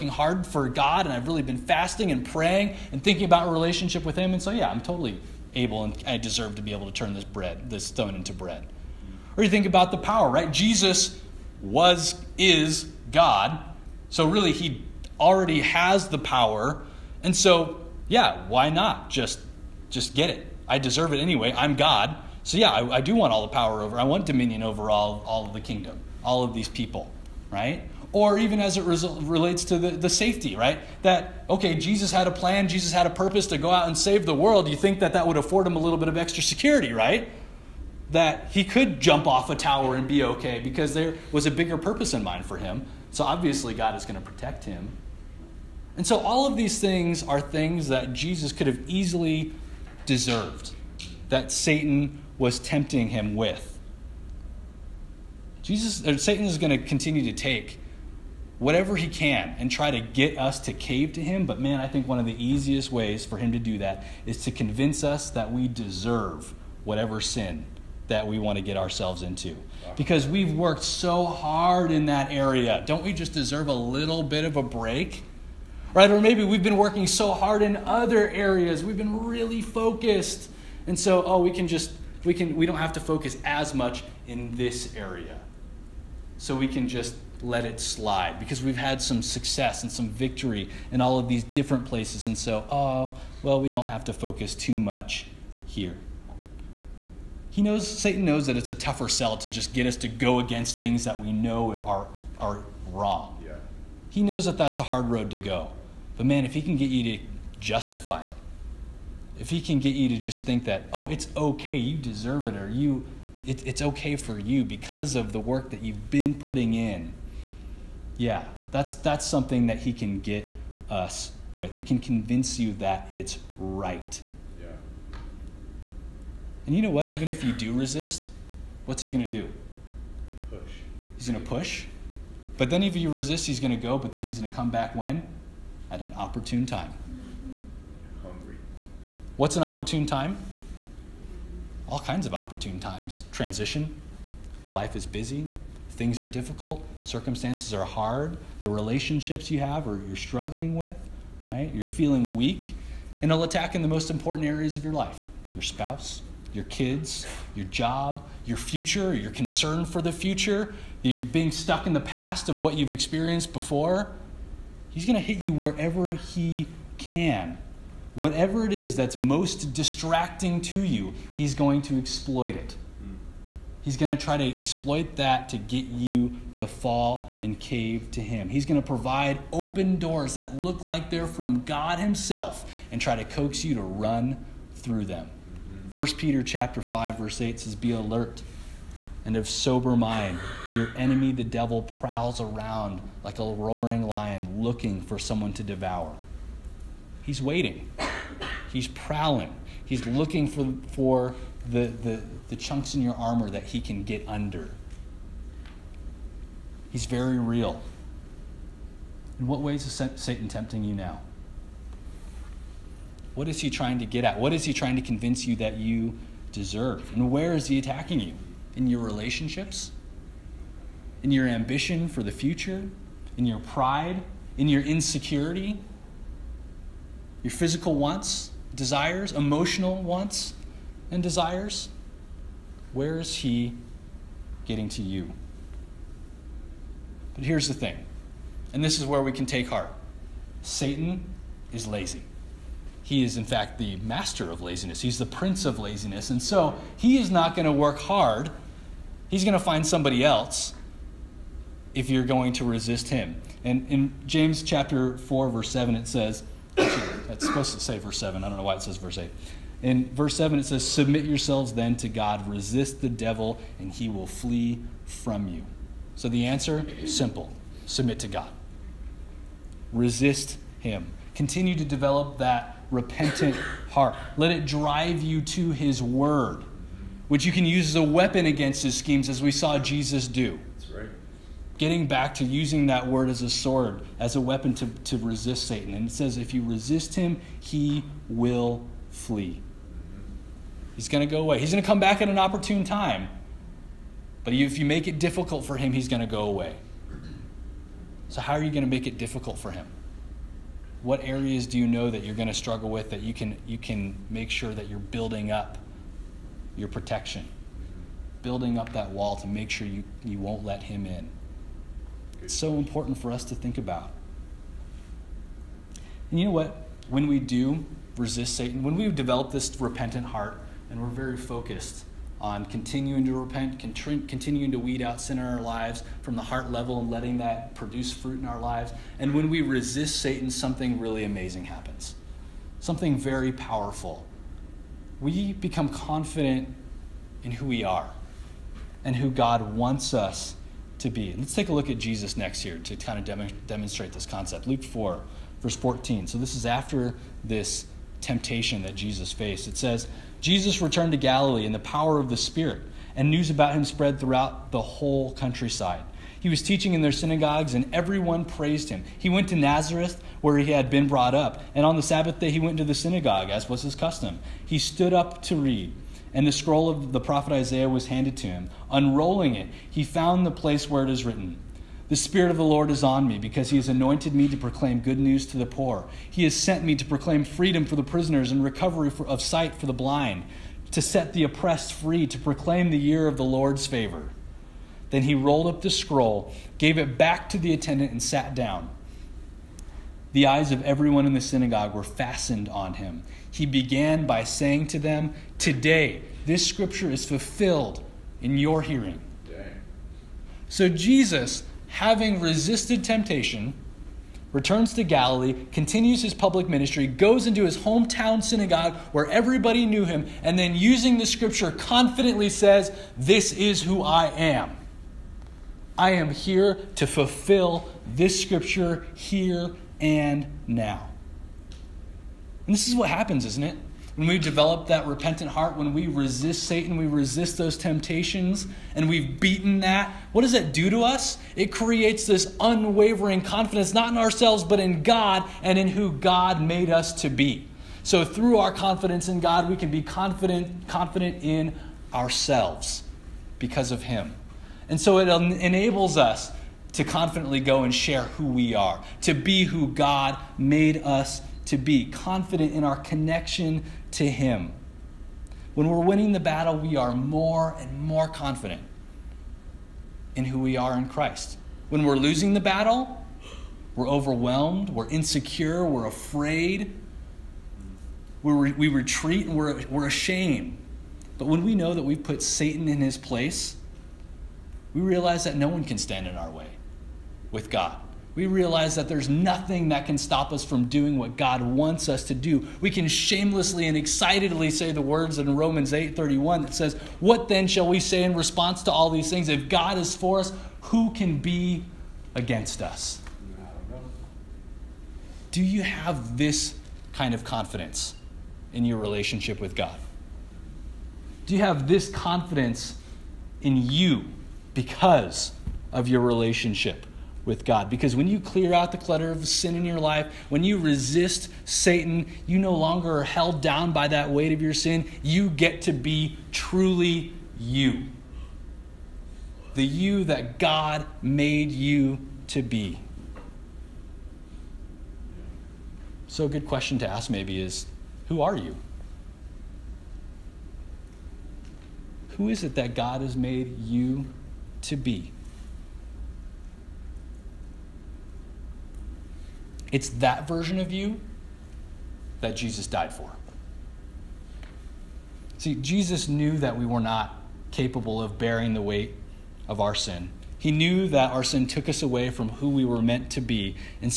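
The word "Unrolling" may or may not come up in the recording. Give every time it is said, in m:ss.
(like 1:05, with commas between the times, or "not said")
6:08.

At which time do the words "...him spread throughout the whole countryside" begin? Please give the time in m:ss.
5:53.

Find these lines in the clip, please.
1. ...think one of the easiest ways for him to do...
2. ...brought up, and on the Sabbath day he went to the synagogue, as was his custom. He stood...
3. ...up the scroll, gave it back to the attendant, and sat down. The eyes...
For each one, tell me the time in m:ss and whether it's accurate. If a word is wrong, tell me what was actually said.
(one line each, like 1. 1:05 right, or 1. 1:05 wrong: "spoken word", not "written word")
1. 1:01 right
2. 6:01 right
3. 6:25 right.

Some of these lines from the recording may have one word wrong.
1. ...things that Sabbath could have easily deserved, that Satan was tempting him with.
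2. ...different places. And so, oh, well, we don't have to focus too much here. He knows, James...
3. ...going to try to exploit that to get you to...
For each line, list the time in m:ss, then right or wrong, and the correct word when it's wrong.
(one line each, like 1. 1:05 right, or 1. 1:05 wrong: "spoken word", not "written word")
1. 0:47 wrong: "Jesus", not "Sabbath"
2. 1:31 wrong: "Satan", not "James"
3. 2:53 right.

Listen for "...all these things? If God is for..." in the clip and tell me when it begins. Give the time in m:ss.
8:08.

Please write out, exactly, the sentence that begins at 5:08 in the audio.
Building up that wall to make sure you, you won't let him in.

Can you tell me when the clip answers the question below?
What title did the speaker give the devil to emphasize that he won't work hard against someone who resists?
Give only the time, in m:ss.
4:05.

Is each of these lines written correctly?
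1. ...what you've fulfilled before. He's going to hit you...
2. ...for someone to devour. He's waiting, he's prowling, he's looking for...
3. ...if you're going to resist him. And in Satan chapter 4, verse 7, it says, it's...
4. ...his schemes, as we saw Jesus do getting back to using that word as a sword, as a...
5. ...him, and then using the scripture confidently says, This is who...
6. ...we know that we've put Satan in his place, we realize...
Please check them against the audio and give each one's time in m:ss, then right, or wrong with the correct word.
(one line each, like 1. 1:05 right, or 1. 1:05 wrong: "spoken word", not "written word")
1. 2:42 wrong: "experienced", not "fulfilled"
2. 3:15 right
3. 4:11 wrong: "James", not "Satan"
4. 4:38 right
5. 6:50 right
6. 7:51 right.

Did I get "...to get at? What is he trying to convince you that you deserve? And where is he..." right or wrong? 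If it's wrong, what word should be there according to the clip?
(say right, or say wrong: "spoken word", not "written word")
right.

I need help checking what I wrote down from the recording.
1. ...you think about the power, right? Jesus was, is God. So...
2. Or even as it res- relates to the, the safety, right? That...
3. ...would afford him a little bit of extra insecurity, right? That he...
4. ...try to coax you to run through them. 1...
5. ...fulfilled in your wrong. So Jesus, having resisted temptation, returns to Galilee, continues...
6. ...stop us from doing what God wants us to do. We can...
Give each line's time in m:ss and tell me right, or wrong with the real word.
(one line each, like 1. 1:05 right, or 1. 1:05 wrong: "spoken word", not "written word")
1. 0:09 right
2. 0:28 right
3. 0:35 wrong: "security", not "insecurity"
4. 3:03 right
5. 6:37 wrong: "hearing", not "wrong"
6. 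8:00 right.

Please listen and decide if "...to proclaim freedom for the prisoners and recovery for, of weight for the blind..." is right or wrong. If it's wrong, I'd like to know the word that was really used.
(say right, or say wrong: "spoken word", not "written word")
wrong: "sight", not "weight".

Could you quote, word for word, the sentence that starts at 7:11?
It creates this unwavering confidence, not in ourselves, but in God and in who God made us to be.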